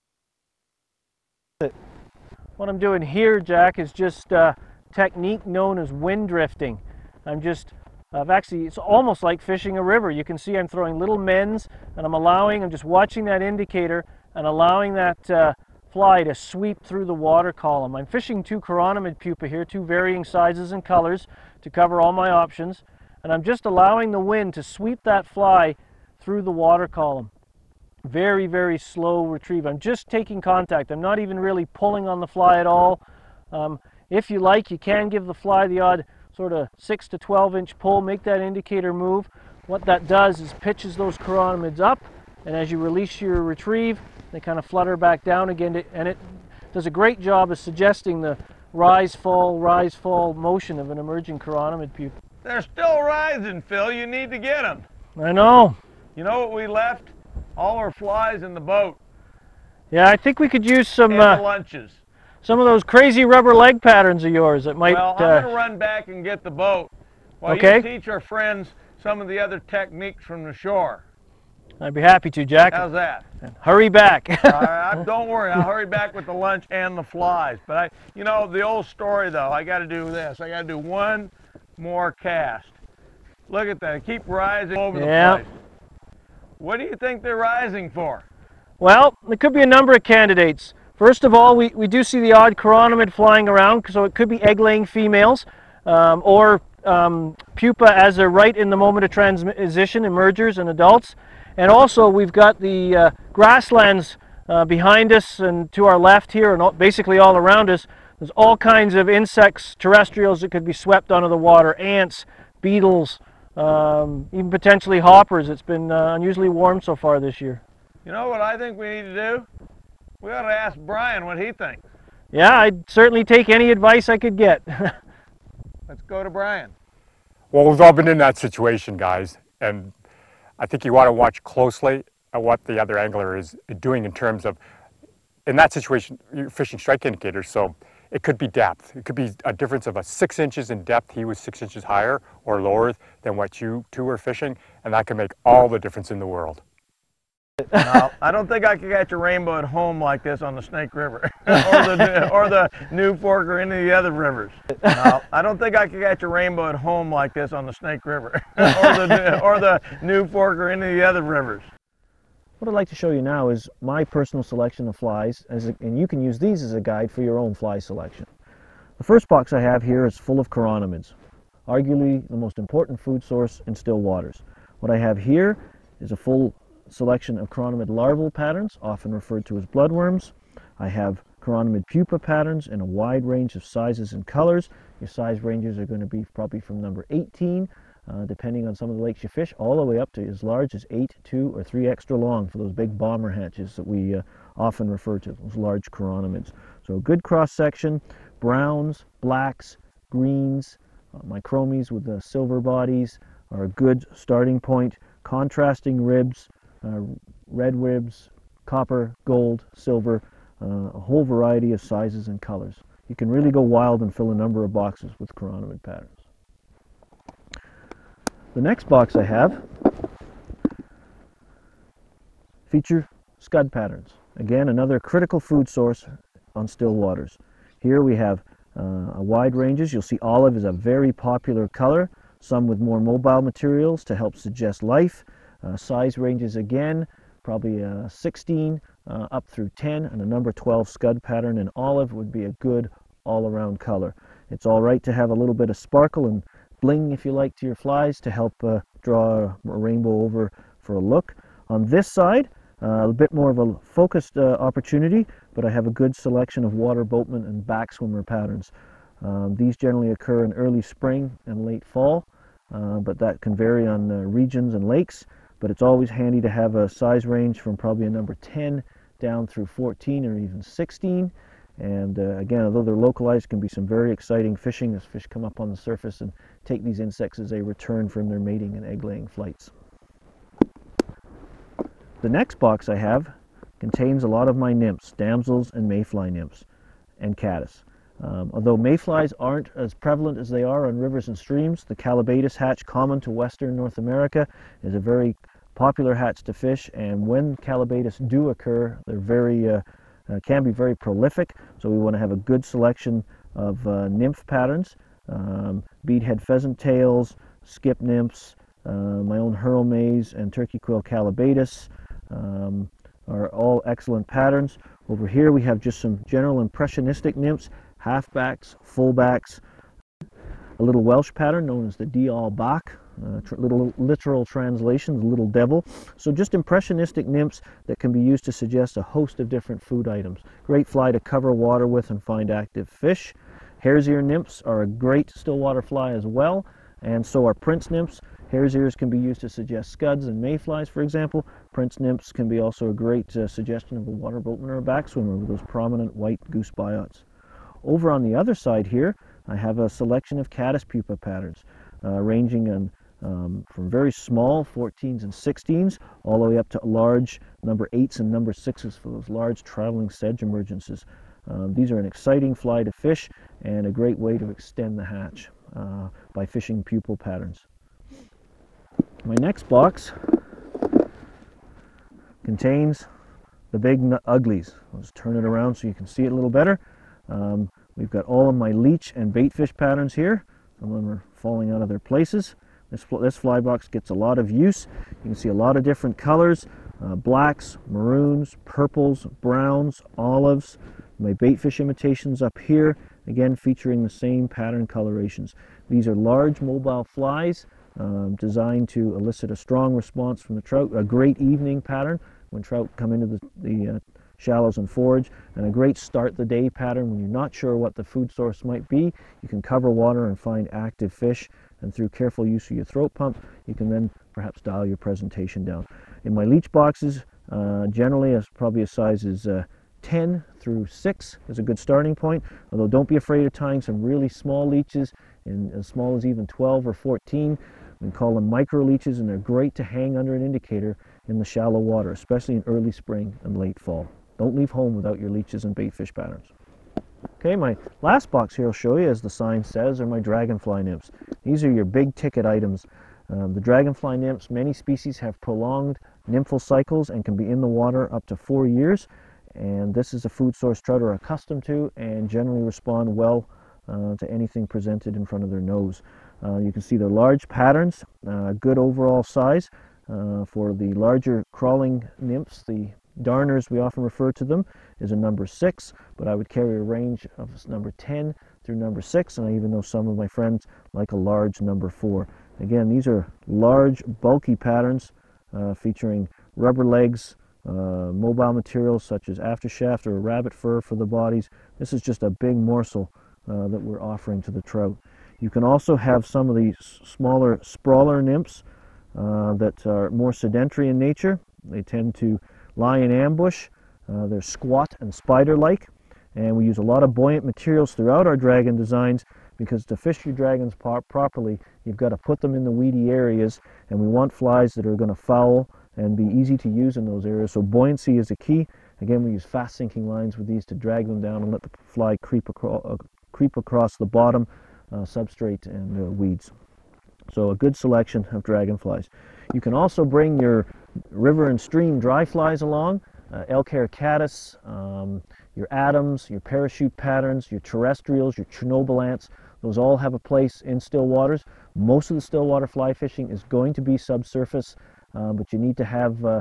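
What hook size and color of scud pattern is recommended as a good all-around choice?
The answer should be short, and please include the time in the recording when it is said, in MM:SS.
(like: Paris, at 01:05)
Number 12 olive, at 04:00.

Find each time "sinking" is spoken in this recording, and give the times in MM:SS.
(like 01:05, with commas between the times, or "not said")
08:29.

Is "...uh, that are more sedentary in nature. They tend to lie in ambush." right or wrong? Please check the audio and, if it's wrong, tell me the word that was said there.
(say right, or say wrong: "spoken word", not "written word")
right.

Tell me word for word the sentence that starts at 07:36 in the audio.
Uh, you can see their large patterns, uh, good overall size.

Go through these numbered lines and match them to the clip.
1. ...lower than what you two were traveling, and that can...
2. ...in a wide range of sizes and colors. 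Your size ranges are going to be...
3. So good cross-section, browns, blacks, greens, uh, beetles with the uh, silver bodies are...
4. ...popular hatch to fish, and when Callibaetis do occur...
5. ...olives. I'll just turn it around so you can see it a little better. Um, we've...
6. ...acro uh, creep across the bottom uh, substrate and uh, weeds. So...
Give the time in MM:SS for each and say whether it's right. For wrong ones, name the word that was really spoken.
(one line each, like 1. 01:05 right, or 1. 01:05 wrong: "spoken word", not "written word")
1. 02:22 wrong: "fishing", not "traveling"
2. 03:02 right
3. 03:16 wrong: "micromies", not "beetles"
4. 04:55 right
5. 06:14 wrong: "uglies", not "olives"
6. 08:32 right.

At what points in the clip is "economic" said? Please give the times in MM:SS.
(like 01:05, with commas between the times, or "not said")
not said.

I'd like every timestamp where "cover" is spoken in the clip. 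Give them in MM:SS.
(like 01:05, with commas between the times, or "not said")
00:21, 05:31, 06:49.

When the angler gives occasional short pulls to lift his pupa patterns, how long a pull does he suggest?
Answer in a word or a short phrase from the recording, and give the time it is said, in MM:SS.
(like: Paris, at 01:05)
6 to 12 inches, at 00:36.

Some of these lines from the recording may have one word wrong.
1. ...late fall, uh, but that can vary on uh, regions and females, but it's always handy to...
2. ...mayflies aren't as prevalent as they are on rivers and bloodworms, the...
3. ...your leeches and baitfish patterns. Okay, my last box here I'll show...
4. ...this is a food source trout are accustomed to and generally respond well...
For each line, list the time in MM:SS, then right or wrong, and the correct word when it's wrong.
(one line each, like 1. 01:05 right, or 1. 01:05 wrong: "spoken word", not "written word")
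1. 04:21 wrong: "lakes", not "females"
2. 04:48 wrong: "streams", not "bloodworms"
3. 07:15 right
4. 07:29 right.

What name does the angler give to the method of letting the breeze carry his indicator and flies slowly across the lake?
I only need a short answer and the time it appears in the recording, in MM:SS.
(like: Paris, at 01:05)
Wind drifting, at 00:05.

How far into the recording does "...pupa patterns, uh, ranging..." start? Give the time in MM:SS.
05:50.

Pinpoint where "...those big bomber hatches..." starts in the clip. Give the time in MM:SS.
03:12.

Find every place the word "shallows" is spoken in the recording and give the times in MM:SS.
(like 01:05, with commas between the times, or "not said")
06:44, 07:11.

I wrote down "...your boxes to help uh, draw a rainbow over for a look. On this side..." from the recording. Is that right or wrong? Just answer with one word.
wrong.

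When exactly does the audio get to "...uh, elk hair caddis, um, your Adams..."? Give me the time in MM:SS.
08:43.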